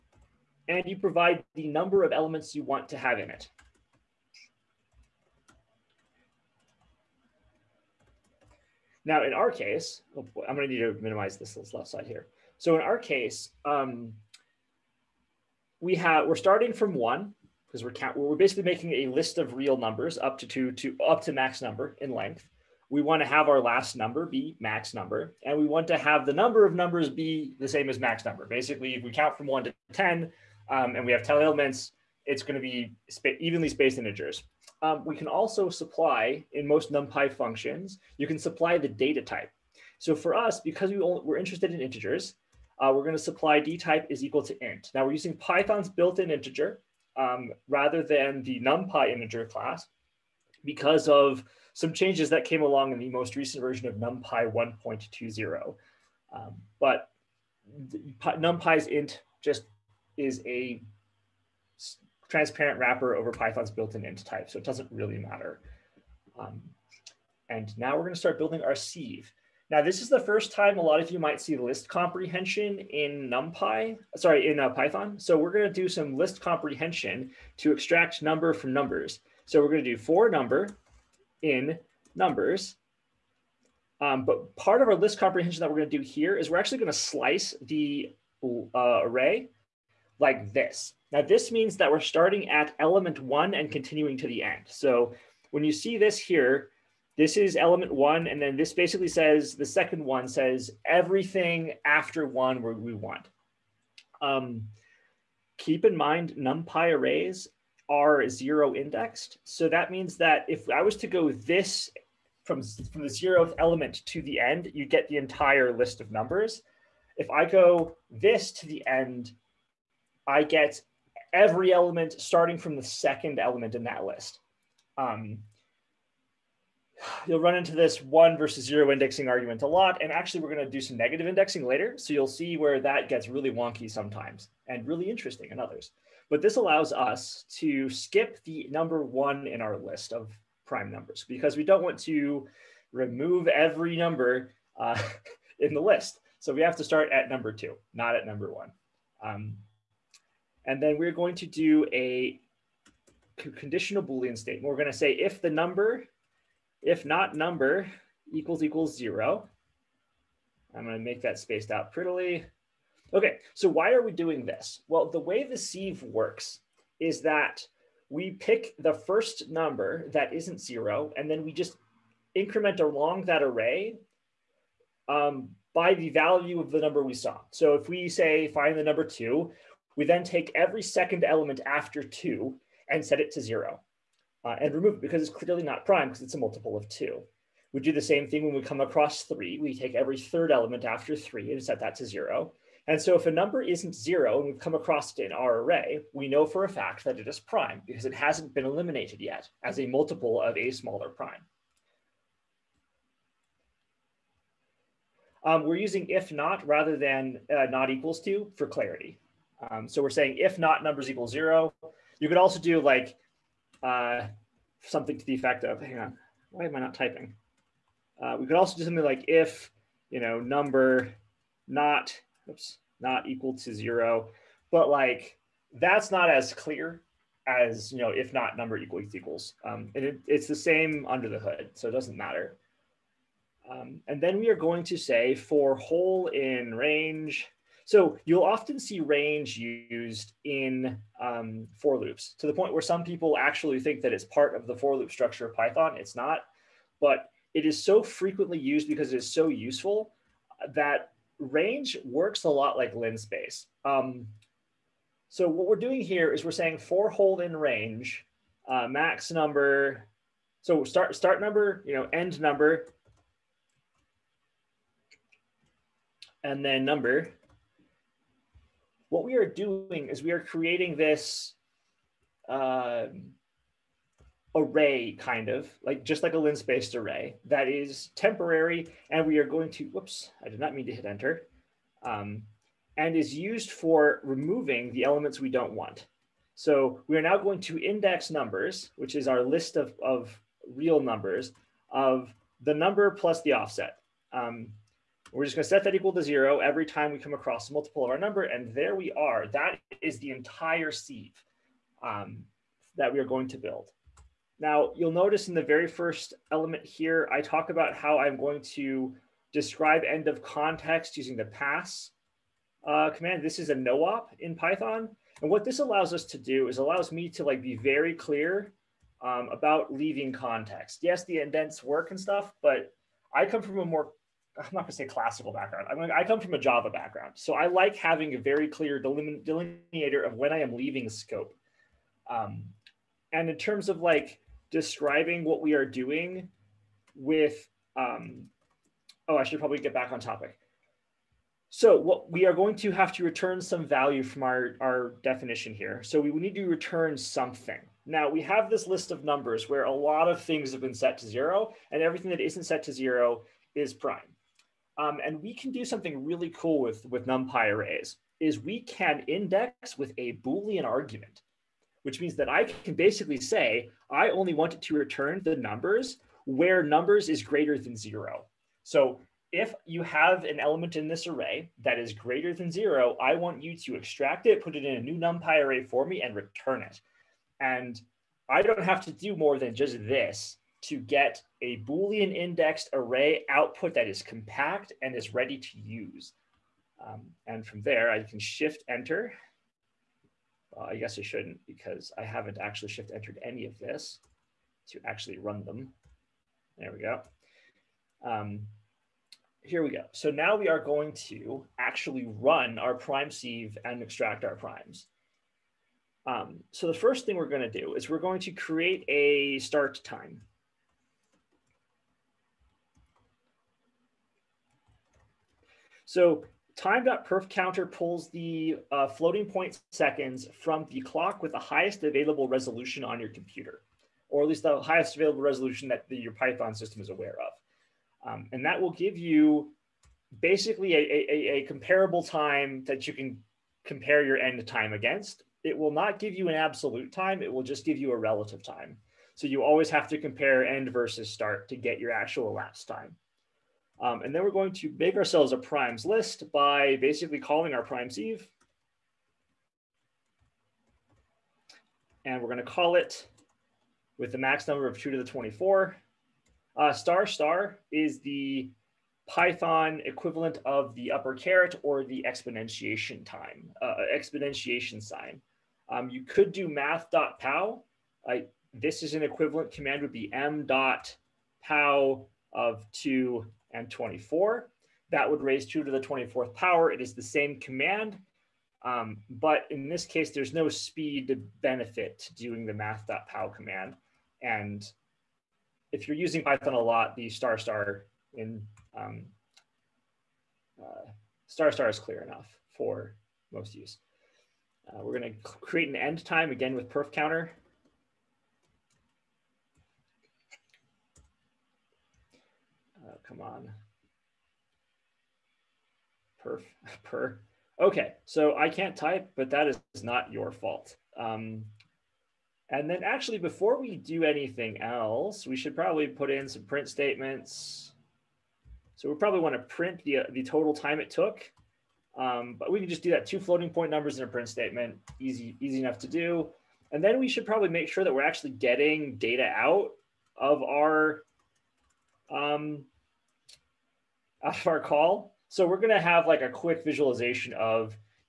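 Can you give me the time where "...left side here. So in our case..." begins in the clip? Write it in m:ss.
0:11.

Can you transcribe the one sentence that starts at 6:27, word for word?
Um, and from there, I can shift enter.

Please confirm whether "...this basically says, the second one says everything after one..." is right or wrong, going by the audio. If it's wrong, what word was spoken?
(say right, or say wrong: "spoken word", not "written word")
right.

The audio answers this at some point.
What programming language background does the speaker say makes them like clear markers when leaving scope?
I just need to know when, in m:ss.
5:26.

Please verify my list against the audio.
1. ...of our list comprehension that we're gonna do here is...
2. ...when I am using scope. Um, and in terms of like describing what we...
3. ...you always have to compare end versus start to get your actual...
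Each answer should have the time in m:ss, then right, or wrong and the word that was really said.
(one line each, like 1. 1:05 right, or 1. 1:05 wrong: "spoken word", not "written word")
1. 1:24 right
2. 5:30 wrong: "leaving", not "using"
3. 7:19 right.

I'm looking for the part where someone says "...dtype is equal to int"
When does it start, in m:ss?
0:43.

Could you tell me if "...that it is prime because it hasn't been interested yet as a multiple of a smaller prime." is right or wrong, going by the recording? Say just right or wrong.
wrong.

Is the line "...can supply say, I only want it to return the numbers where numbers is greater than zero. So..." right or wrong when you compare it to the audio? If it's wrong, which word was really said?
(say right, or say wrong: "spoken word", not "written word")
wrong: "basically", not "supply".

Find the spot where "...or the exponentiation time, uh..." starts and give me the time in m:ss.
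7:41.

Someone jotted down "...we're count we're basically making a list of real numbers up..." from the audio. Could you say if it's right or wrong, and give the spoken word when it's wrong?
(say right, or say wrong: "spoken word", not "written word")
right.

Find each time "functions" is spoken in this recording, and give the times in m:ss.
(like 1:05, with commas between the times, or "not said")
0:37.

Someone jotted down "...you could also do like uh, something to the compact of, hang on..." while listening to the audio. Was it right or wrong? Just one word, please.
wrong.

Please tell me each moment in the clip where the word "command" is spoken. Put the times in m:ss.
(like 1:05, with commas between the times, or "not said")
5:13, 7:49, 7:57, 8:03.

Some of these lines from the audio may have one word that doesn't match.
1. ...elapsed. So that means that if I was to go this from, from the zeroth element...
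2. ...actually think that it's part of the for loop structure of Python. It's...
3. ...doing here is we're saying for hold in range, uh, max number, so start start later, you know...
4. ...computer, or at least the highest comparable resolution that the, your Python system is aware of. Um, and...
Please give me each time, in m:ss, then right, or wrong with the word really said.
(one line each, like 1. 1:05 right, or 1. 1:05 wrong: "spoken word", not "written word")
1. 1:48 wrong: "indexed", not "elapsed"
2. 4:03 right
3. 4:15 wrong: "number", not "later"
4. 7:03 wrong: "available", not "comparable".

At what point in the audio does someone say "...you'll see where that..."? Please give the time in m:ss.
2:12.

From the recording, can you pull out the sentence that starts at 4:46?
So we are now going to index numbers, which is our list of, of real numbers of the number plus the offset.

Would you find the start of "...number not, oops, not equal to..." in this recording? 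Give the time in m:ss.
3:40.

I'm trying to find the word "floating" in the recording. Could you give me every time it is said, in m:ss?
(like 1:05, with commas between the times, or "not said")
6:59, 8:43.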